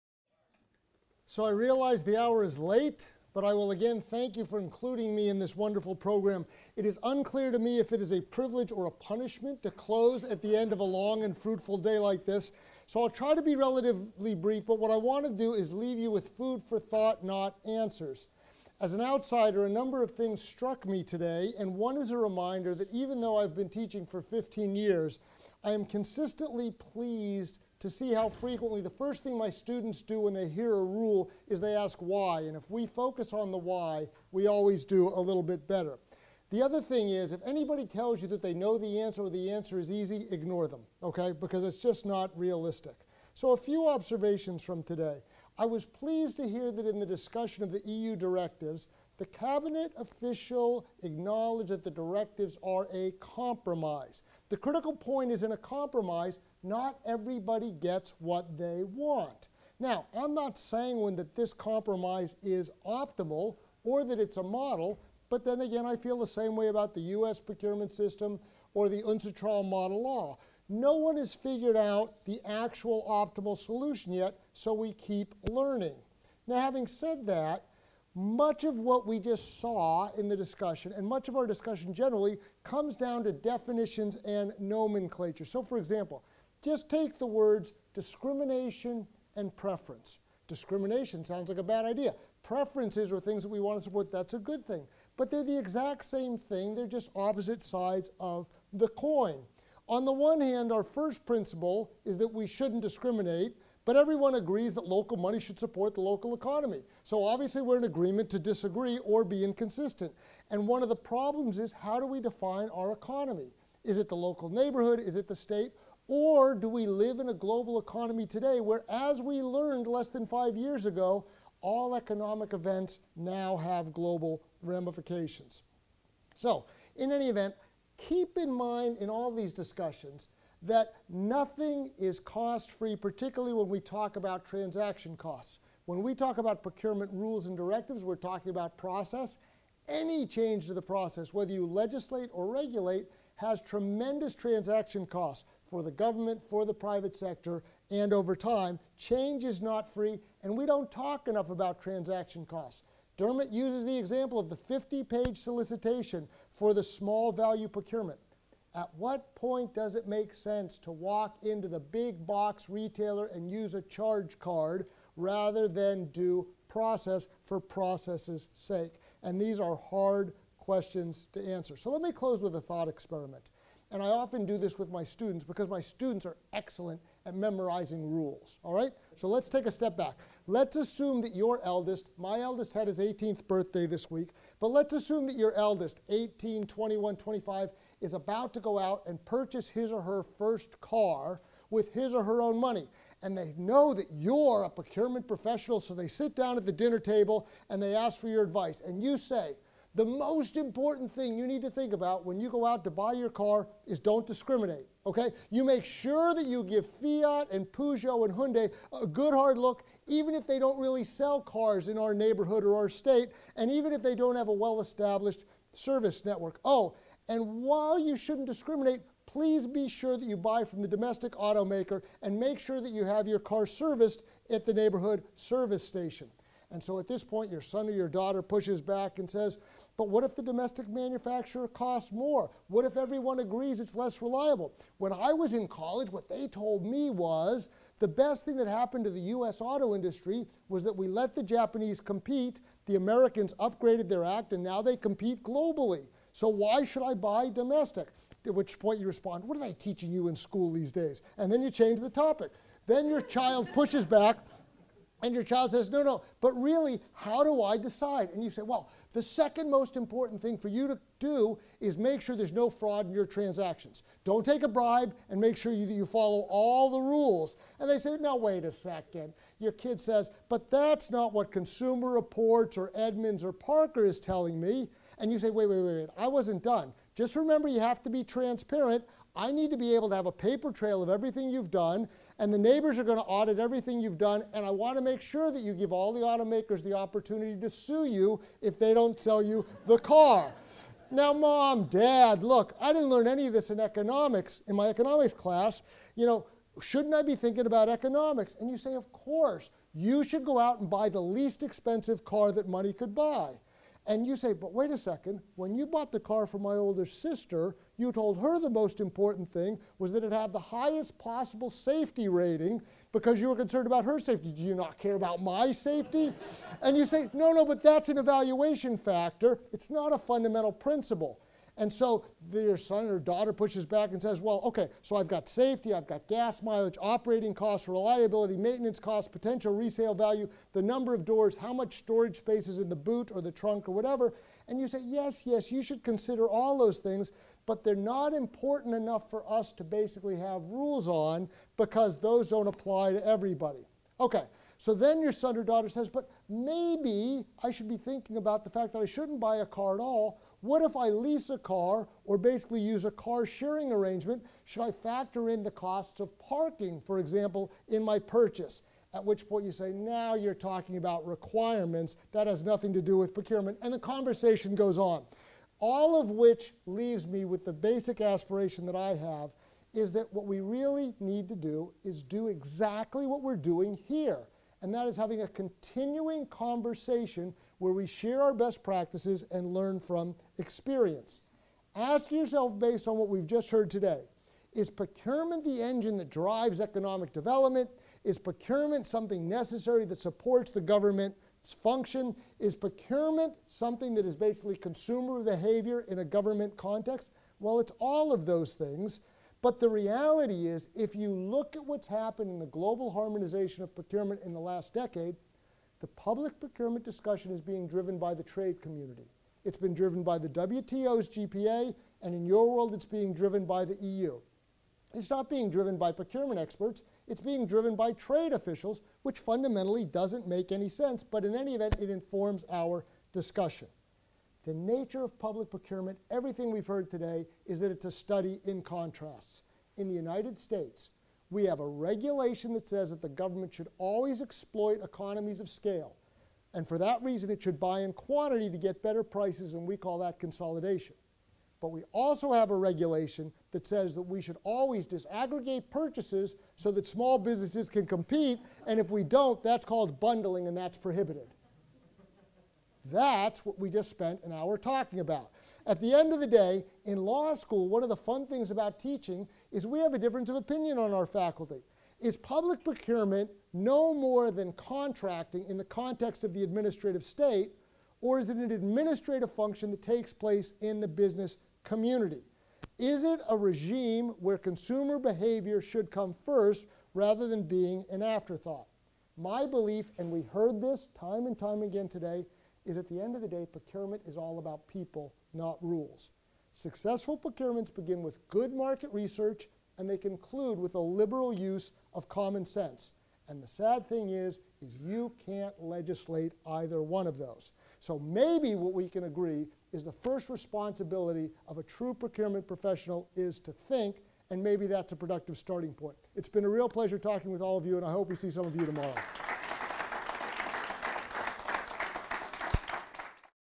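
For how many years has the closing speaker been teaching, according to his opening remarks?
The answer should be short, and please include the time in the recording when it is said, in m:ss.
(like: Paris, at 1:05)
15, at 0:24.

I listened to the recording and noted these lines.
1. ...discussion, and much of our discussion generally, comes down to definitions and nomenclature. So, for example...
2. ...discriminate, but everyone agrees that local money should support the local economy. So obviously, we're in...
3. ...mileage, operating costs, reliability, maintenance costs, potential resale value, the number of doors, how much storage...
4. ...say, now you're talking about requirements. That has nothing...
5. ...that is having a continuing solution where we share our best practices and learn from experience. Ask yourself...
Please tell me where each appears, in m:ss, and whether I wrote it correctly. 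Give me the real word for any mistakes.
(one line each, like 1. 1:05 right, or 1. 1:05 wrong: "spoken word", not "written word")
1. 1:20 right
2. 1:42 right
3. 5:26 right
4. 5:59 right
5. 6:14 wrong: "conversation", not "solution".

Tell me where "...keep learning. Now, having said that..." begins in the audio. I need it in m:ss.
1:14.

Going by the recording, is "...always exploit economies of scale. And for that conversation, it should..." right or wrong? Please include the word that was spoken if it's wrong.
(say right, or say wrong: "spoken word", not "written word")
wrong: "reason", not "conversation".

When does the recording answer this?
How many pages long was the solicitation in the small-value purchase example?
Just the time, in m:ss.
2:34.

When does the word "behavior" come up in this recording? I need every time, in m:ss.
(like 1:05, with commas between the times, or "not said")
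6:35, 7:55.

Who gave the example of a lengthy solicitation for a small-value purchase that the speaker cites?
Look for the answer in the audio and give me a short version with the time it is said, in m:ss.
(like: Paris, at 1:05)
Dermot, at 2:33.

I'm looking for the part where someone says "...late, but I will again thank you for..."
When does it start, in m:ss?
0:02.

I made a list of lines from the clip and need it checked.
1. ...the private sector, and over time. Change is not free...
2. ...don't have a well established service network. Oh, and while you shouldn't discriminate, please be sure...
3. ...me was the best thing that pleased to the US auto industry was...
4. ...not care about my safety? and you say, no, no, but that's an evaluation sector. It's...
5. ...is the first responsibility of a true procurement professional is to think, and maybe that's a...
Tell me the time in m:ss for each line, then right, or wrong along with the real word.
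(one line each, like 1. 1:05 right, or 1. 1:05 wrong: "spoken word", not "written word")
1. 2:26 right
2. 3:34 right
3. 3:56 wrong: "happened", not "pleased"
4. 5:14 wrong: "factor", not "sector"
5. 8:19 right.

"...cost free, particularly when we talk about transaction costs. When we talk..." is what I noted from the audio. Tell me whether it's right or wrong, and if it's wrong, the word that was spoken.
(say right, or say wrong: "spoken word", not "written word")
right.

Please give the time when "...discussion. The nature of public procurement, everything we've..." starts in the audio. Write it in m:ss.
7:03.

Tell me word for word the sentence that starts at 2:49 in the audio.
And these are hard questions to answer.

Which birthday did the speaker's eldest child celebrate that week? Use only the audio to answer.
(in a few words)
18th.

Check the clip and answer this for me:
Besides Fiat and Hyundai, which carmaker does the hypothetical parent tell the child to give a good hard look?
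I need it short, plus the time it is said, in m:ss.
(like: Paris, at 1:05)
Peugeot, at 3:27.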